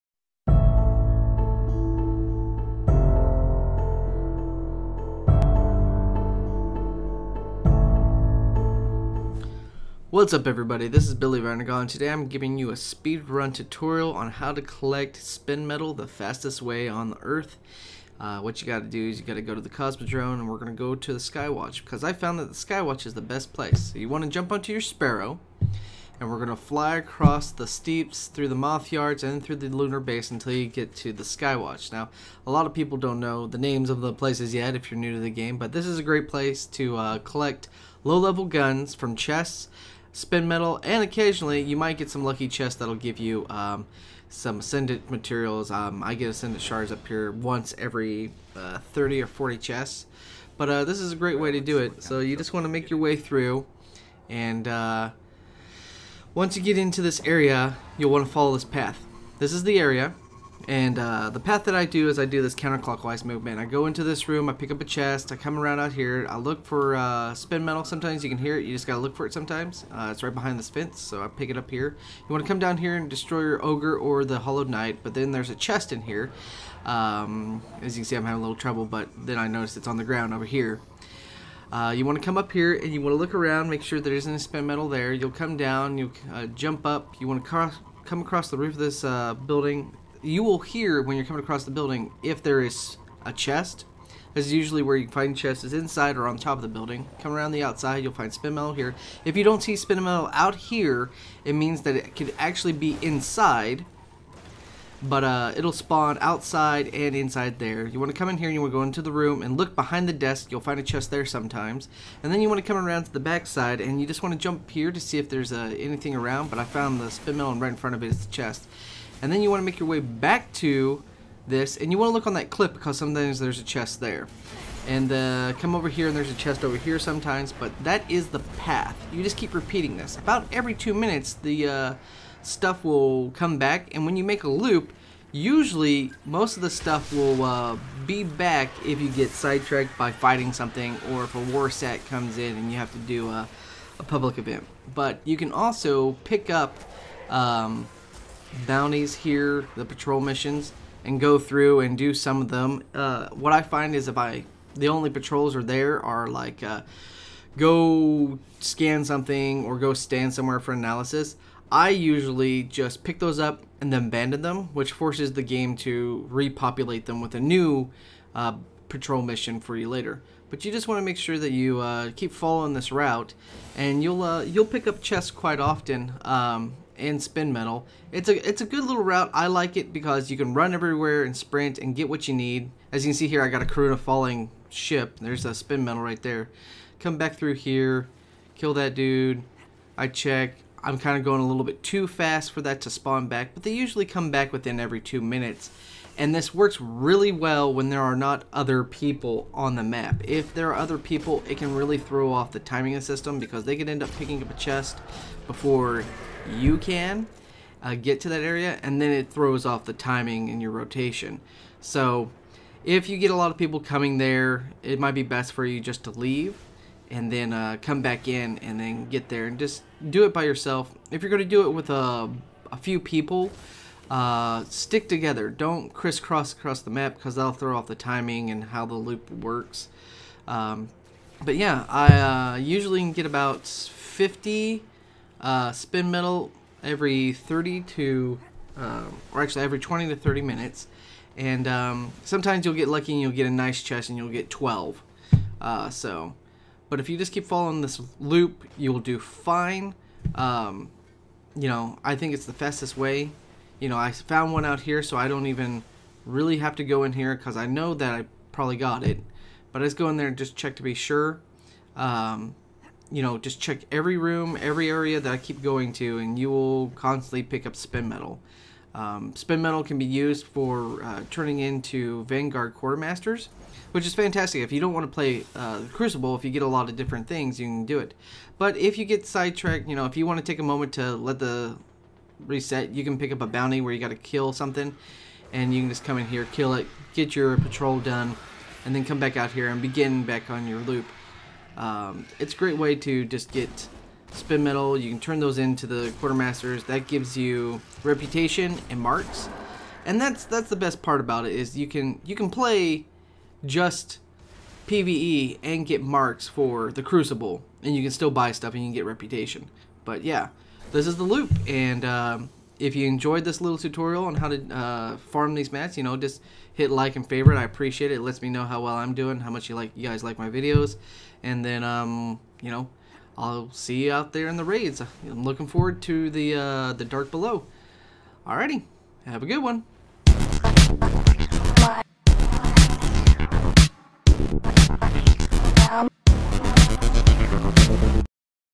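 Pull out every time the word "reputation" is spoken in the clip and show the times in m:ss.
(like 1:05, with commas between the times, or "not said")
4:58, 5:09.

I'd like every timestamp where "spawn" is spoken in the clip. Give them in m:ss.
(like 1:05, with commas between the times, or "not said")
1:45, 3:12.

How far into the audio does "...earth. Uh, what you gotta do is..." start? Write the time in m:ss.
0:17.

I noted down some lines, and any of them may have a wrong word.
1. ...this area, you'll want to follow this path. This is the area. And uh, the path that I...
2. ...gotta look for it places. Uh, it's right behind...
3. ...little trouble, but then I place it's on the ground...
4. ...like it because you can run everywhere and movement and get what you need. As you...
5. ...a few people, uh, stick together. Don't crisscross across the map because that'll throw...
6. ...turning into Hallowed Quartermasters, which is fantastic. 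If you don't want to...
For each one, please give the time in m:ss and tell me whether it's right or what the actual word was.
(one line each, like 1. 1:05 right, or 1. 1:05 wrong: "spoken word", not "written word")
1. 0:57 right
2. 1:08 wrong: "sometimes", not "places"
3. 1:18 wrong: "notice", not "place"
4. 2:59 wrong: "sprint", not "movement"
5. 3:42 right
6. 4:31 wrong: "Vanguard", not "Hallowed".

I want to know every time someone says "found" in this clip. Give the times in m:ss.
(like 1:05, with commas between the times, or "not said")
0:22, 1:56, 4:14.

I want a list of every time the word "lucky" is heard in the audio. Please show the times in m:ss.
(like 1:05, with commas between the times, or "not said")
0:42, 4:02.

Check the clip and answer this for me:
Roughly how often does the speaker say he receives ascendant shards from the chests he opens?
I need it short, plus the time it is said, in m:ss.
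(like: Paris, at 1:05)
once every 30 or 40 chests, at 0:47.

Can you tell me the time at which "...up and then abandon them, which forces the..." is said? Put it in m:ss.
2:43.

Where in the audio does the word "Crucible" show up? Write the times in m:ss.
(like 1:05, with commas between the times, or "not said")
4:35, 5:07.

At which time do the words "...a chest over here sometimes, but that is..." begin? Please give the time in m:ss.
2:06.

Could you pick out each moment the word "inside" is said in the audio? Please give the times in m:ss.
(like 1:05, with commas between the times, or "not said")
1:35, 1:43, 1:47.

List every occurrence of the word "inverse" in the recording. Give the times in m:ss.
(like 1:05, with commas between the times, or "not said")
not said.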